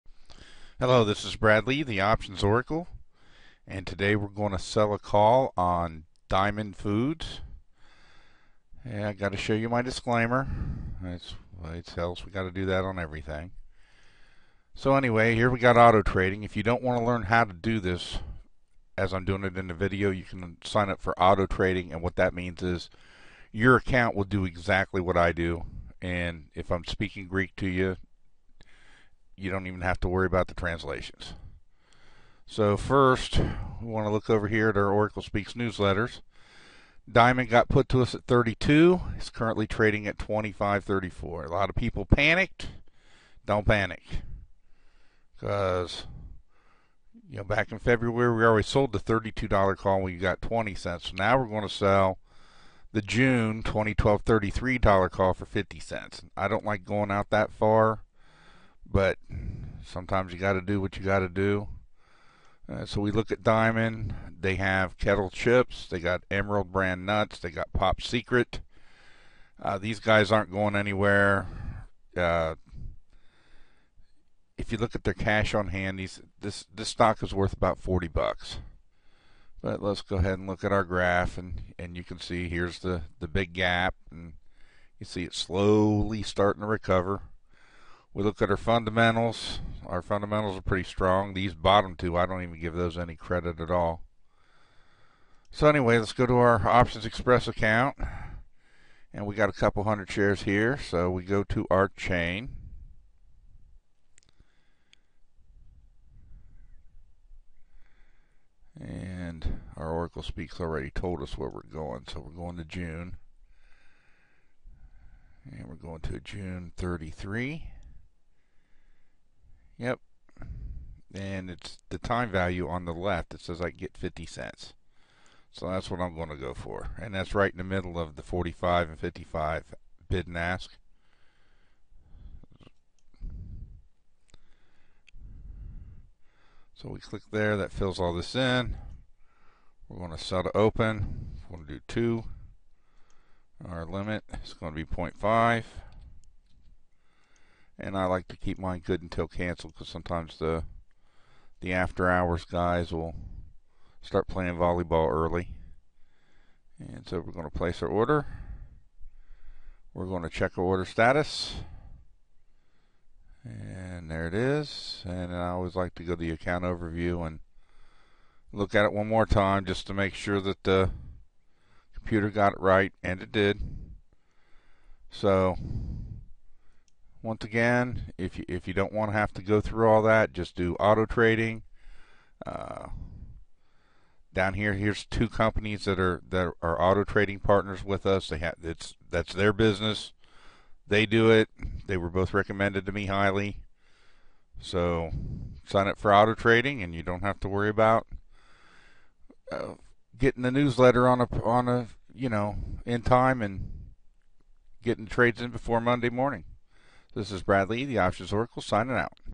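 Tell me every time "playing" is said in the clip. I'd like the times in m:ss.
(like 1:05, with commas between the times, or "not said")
2:34.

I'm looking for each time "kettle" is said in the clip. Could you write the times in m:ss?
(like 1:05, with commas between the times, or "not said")
1:04.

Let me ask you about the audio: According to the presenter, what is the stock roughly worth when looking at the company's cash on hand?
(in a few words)
about $40.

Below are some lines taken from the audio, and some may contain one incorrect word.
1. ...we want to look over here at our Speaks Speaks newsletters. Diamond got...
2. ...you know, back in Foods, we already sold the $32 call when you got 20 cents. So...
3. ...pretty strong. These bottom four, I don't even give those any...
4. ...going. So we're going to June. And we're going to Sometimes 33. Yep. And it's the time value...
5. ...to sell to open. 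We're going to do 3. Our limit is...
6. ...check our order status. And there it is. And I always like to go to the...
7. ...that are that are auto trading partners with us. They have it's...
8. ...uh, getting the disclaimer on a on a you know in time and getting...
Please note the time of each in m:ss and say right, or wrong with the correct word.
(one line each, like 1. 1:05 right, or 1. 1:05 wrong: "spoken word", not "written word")
1. 0:33 wrong: "Oracle", not "Speaks"
2. 0:47 wrong: "February", not "Foods"
3. 1:30 wrong: "two", not "four"
4. 1:51 wrong: "June", not "Sometimes"
5. 2:20 wrong: "2", not "3"
6. 2:40 right
7. 3:05 right
8. 3:19 wrong: "newsletter", not "disclaimer".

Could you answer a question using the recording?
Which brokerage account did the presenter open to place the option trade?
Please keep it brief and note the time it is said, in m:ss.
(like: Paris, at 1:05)
OptionsXpress, at 1:36.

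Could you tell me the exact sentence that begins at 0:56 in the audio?
I don't like going out that far, but Sometimes you got to do what you got to do.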